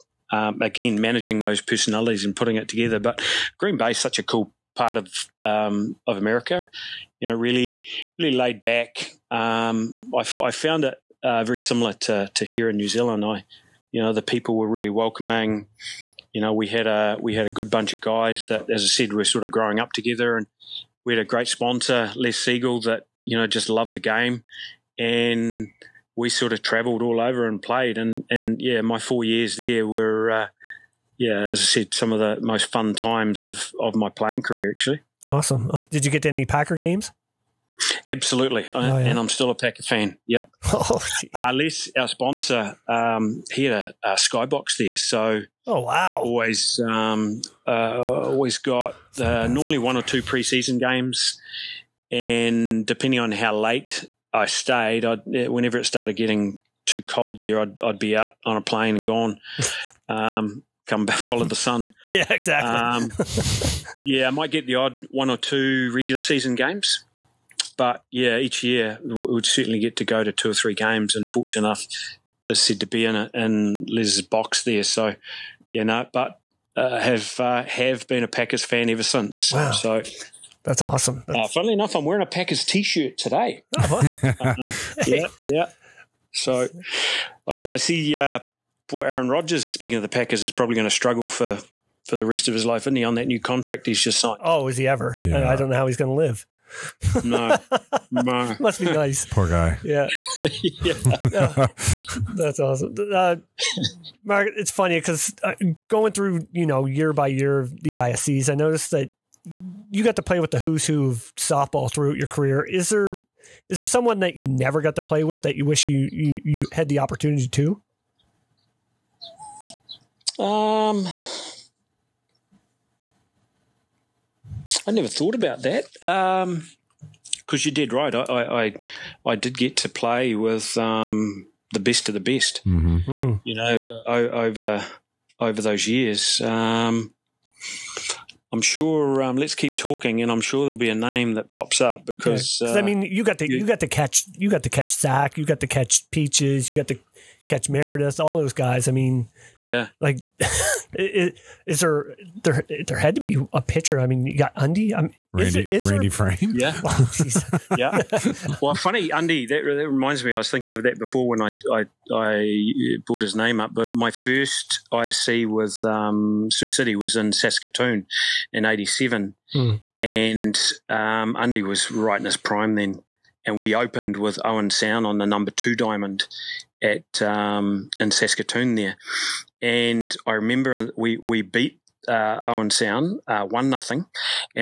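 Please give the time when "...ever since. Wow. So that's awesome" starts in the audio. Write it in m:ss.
1:18.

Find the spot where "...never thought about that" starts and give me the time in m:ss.
2:04.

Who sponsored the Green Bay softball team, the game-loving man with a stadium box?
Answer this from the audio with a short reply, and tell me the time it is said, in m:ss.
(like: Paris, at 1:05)
Les Siegel, at 0:22.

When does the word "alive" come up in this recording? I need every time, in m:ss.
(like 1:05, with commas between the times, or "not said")
not said.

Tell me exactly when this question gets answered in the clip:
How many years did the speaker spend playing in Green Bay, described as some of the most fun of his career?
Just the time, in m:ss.
0:28.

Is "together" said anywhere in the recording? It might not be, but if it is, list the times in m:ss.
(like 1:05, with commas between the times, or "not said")
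0:02, 0:19.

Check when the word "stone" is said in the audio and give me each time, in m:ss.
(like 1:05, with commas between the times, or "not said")
not said.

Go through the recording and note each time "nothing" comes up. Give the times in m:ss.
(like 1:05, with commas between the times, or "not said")
3:03.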